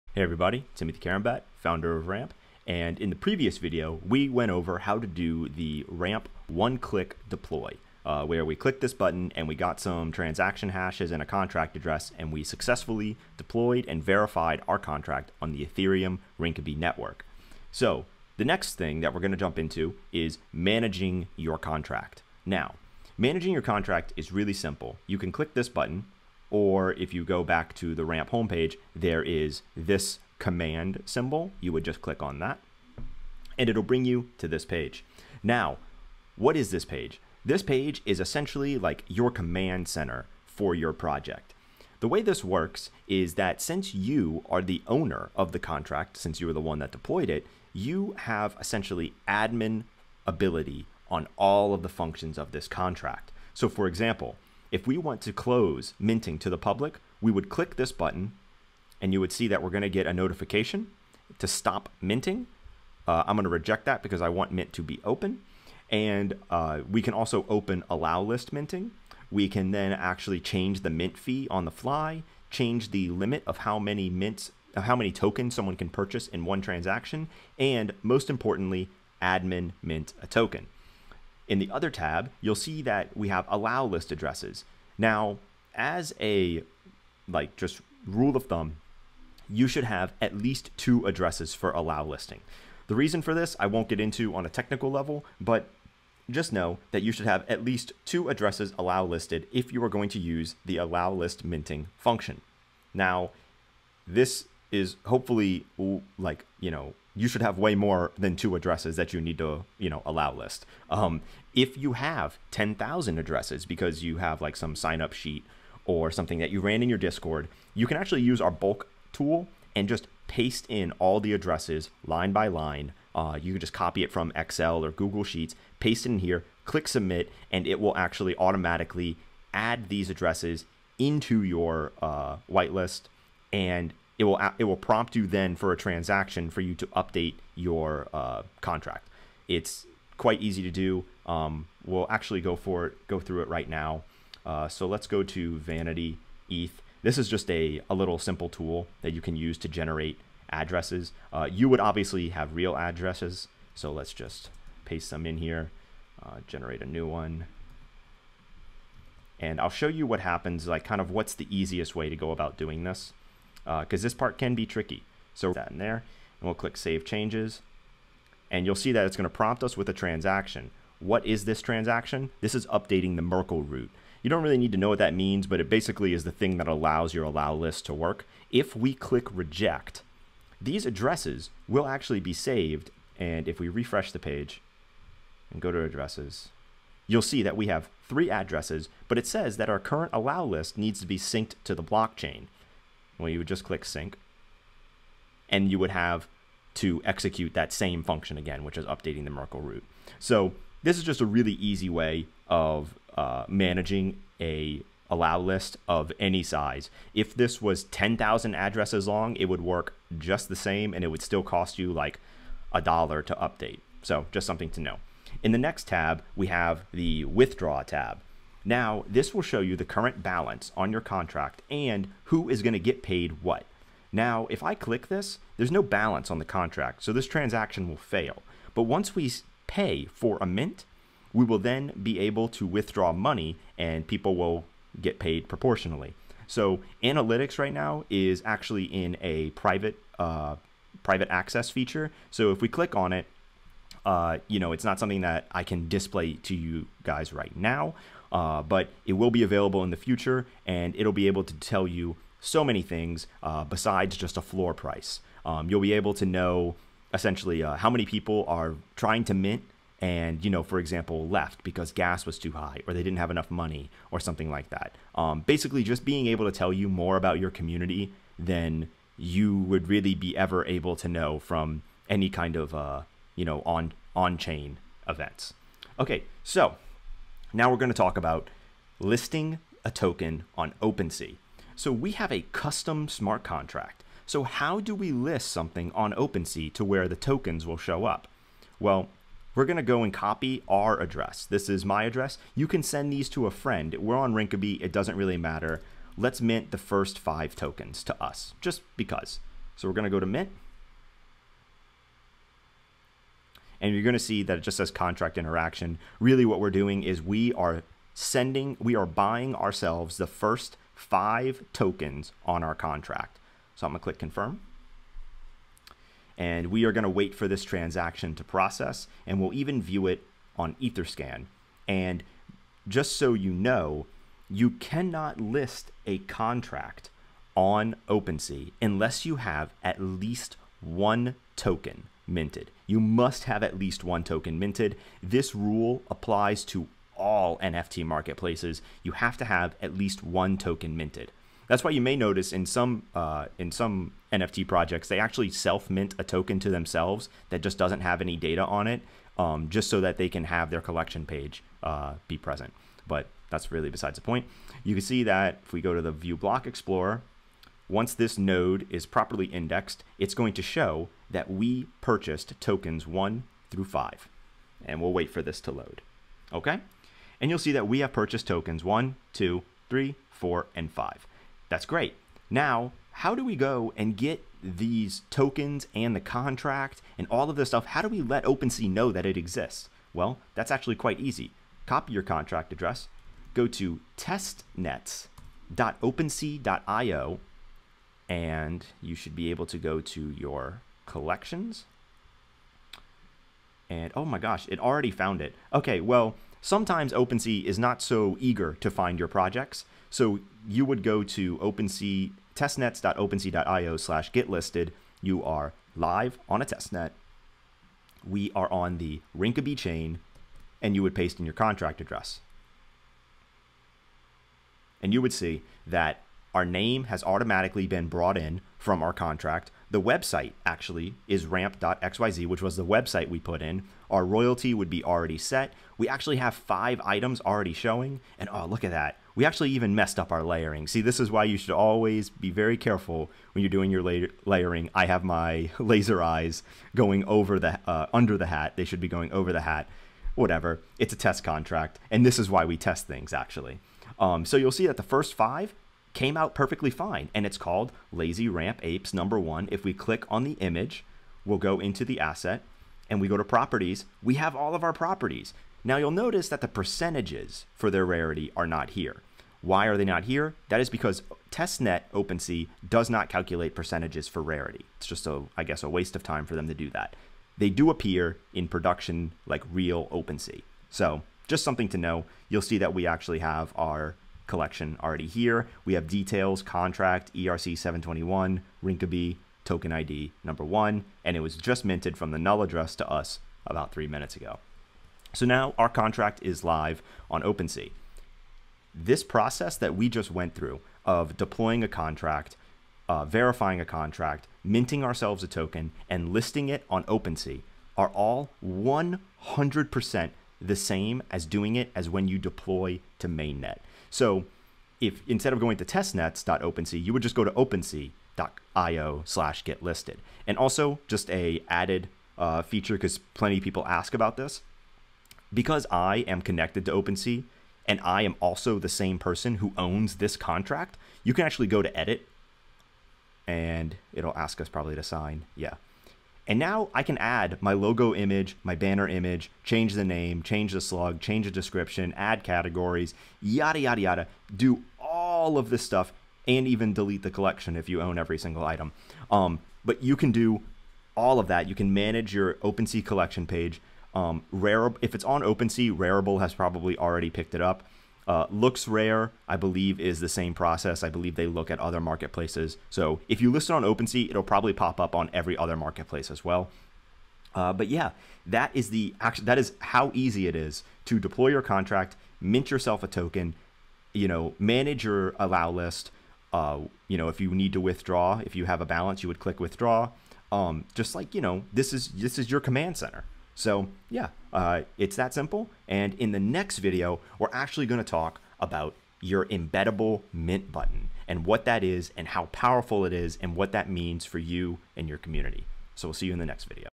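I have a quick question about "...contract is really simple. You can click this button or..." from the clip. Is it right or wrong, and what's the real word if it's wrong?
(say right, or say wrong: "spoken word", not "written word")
right.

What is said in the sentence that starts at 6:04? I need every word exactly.
And we'll wait for this to load.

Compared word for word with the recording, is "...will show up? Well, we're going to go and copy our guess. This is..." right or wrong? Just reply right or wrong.
wrong.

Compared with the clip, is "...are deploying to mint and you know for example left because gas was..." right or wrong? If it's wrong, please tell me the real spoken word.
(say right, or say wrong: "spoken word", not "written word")
wrong: "trying", not "deploying".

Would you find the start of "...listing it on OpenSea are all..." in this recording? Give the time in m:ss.
8:16.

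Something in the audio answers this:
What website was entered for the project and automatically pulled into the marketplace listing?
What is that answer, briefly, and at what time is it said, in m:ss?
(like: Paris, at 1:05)
rampp.xyz, at 7:01.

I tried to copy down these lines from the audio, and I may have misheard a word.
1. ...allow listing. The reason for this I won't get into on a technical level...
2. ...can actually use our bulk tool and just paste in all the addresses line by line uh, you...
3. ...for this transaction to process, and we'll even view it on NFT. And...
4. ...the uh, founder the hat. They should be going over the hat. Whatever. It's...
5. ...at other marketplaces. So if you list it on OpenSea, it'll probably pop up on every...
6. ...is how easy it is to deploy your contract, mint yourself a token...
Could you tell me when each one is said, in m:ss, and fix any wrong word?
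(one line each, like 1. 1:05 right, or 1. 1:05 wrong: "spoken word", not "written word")
1. 1:31 right
2. 1:57 right
3. 5:17 wrong: "Etherscan", not "NFT"
4. 7:17 wrong: "under", not "founder"
5. 9:11 right
6. 9:19 right.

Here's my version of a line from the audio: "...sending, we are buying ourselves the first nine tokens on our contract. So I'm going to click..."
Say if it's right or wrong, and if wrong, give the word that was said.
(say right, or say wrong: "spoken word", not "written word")
wrong: "five", not "nine".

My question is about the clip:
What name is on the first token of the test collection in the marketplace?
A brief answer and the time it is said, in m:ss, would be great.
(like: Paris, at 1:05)
Lazy Ramp Apes, at 7:28.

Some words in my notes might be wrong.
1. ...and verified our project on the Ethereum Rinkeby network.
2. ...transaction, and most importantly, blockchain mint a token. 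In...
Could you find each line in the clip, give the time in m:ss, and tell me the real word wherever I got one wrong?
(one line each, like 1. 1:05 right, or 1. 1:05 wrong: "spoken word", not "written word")
1. 0:13 wrong: "contract", not "project"
2. 1:16 wrong: "admin", not "blockchain".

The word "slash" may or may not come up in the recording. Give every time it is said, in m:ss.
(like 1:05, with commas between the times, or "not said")
6:43, 8:29.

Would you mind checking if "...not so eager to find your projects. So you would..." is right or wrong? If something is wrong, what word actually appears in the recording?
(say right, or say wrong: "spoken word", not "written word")
right.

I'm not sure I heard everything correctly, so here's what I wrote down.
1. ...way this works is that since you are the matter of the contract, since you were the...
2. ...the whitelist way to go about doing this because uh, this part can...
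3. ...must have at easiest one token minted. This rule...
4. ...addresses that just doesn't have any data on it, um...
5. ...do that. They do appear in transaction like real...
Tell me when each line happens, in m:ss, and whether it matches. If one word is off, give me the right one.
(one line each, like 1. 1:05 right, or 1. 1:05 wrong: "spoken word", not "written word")
1. 0:42 wrong: "owner", not "matter"
2. 2:41 wrong: "easiest", not "whitelist"
3. 5:32 wrong: "least", not "easiest"
4. 5:46 wrong: "themselves", not "addresses"
5. 7:46 wrong: "production", not "transaction".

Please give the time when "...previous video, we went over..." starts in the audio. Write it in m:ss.
0:03.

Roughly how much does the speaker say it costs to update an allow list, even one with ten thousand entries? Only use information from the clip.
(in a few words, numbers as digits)
a dollar.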